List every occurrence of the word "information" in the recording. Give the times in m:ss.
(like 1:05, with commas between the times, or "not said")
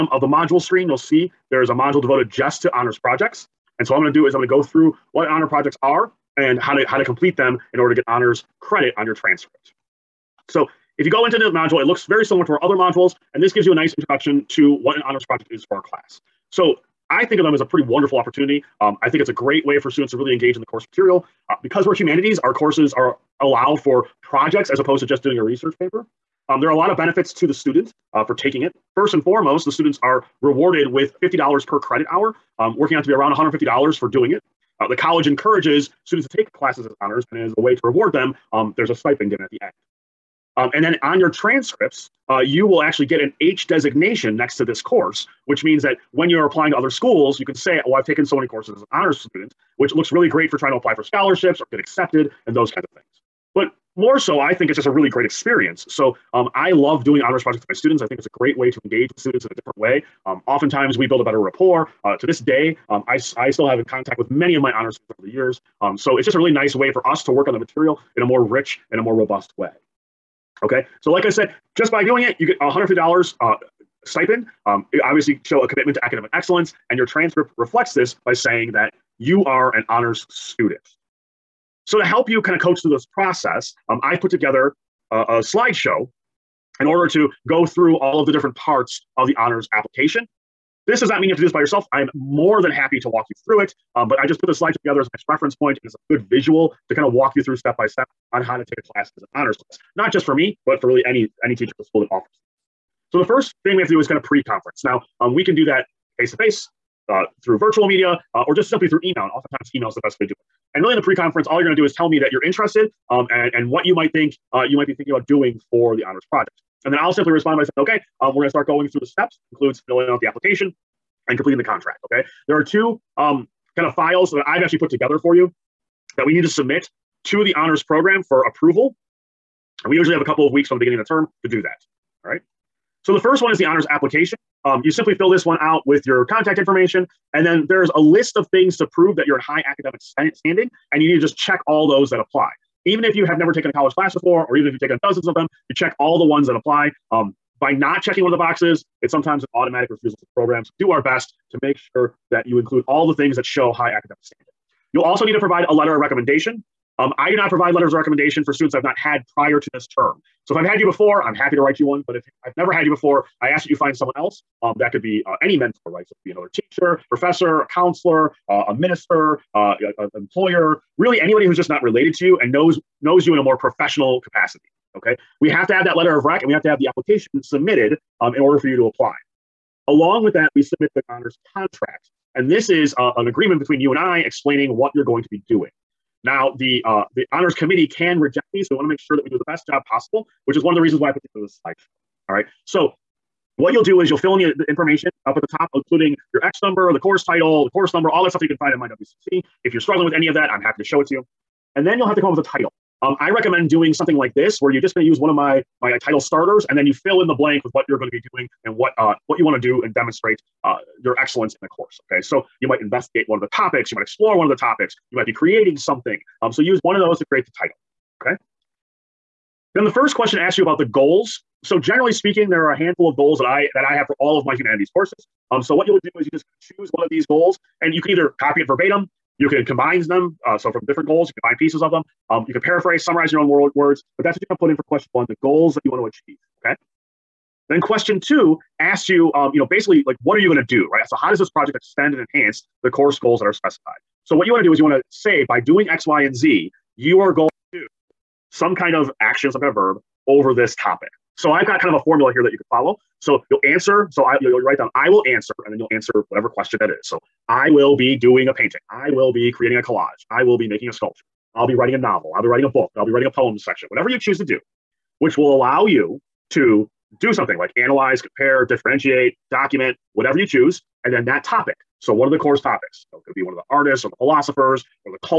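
2:16, 3:14.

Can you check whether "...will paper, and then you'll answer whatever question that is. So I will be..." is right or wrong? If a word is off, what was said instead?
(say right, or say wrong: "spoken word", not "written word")
wrong: "answer", not "paper".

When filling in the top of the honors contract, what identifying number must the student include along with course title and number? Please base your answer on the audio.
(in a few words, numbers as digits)
X number.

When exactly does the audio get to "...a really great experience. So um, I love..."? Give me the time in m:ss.
0:54.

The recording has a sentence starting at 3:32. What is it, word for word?
Okay, so you might investigate one of the topics, you might explore one of the topics, you might be creating something.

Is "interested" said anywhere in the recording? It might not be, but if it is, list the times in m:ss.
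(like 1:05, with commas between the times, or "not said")
1:52.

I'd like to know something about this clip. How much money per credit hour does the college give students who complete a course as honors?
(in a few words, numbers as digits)
$50.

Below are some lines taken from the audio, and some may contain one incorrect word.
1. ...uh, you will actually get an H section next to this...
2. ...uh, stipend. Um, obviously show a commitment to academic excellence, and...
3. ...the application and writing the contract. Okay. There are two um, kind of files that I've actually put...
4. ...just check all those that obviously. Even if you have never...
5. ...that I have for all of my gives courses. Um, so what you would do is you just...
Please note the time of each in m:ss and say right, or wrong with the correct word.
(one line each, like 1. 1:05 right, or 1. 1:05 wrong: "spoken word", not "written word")
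1. 0:42 wrong: "designation", not "section"
2. 1:13 right
3. 2:00 wrong: "completing", not "writing"
4. 2:21 wrong: "apply", not "obviously"
5. 3:43 wrong: "humanities", not "gives".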